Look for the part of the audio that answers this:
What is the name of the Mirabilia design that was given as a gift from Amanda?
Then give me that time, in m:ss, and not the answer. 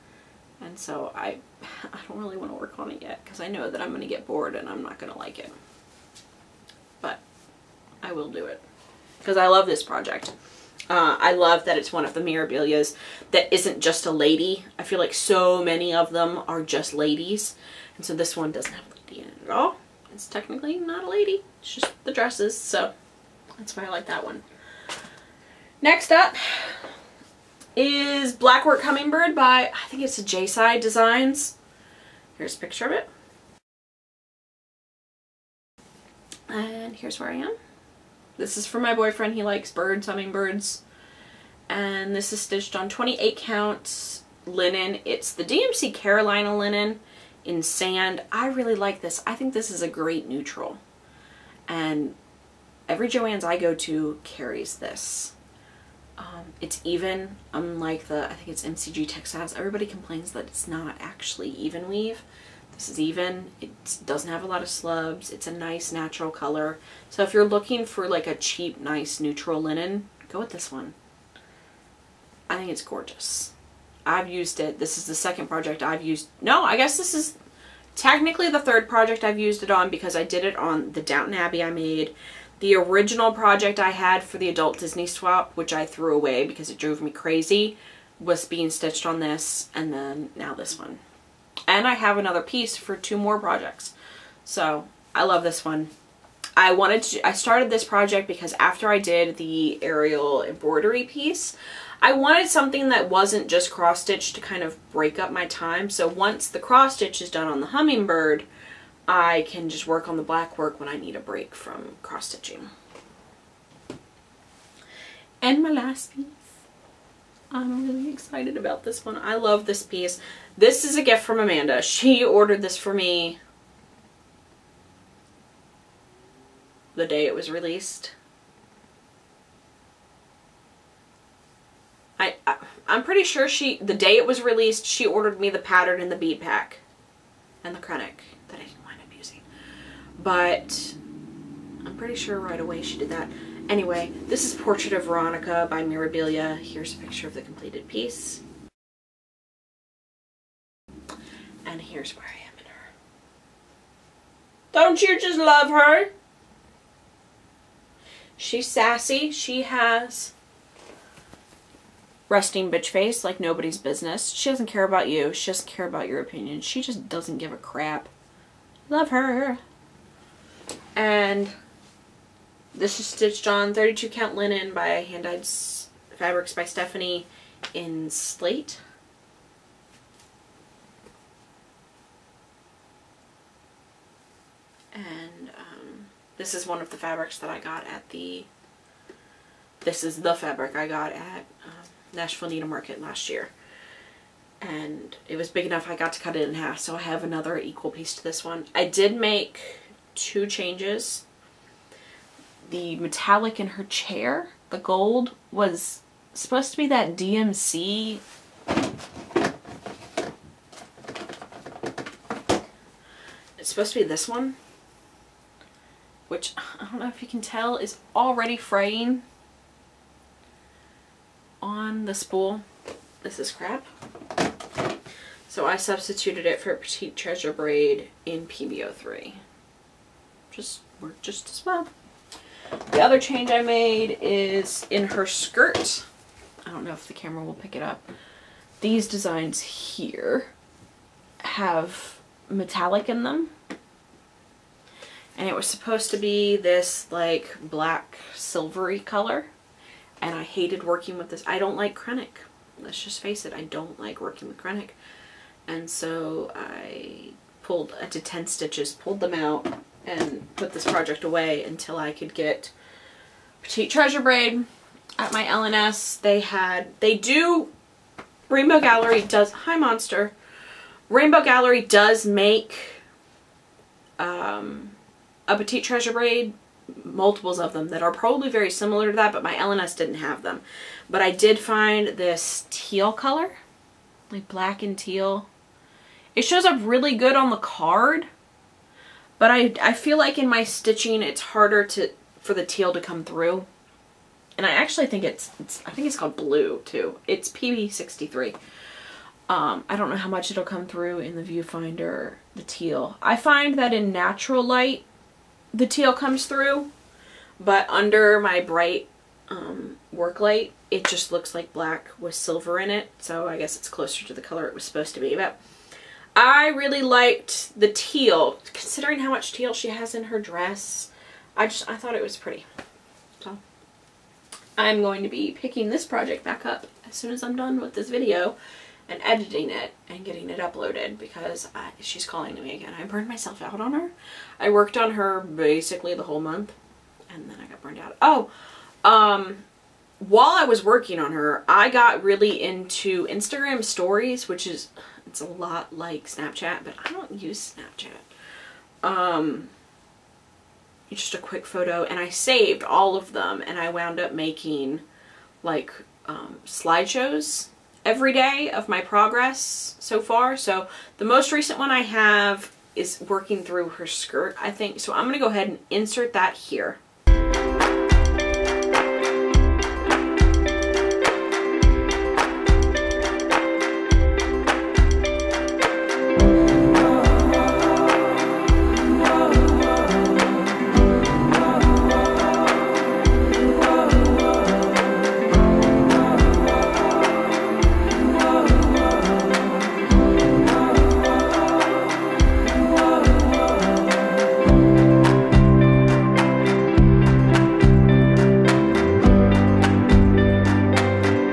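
2:24.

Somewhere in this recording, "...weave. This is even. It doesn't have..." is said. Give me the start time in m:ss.
1:01.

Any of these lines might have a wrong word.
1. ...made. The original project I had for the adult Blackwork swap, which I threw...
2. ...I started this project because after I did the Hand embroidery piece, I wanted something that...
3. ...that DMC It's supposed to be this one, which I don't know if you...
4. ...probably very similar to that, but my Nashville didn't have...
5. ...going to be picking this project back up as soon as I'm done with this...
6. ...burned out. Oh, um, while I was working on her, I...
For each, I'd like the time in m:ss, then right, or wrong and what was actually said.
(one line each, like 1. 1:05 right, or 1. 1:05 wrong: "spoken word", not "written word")
1. 1:21 wrong: "Disney", not "Blackwork"
2. 1:37 wrong: "Ariel", not "Hand"
3. 3:26 right
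4. 4:38 wrong: "LNS", not "Nashville"
5. 5:25 right
6. 5:37 right.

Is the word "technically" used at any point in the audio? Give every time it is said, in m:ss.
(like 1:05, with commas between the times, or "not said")
0:20, 1:17.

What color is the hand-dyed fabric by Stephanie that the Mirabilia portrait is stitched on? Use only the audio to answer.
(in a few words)
Slate.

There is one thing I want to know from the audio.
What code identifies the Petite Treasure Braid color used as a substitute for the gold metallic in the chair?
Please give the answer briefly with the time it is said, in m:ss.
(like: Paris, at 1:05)
PBO3, at 3:48.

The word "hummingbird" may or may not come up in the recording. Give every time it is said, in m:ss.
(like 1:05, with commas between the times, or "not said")
0:28, 0:40, 1:47.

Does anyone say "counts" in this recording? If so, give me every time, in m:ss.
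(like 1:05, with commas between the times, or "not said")
0:43, 2:54.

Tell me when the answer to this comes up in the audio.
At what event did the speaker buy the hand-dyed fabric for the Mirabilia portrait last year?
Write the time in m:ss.
3:12.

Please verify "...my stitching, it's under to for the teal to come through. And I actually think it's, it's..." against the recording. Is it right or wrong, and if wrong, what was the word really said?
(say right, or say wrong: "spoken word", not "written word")
wrong: "harder", not "under".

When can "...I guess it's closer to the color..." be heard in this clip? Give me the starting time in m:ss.
5:13.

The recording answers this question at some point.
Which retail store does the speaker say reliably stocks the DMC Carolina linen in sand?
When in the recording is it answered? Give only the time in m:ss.
0:53.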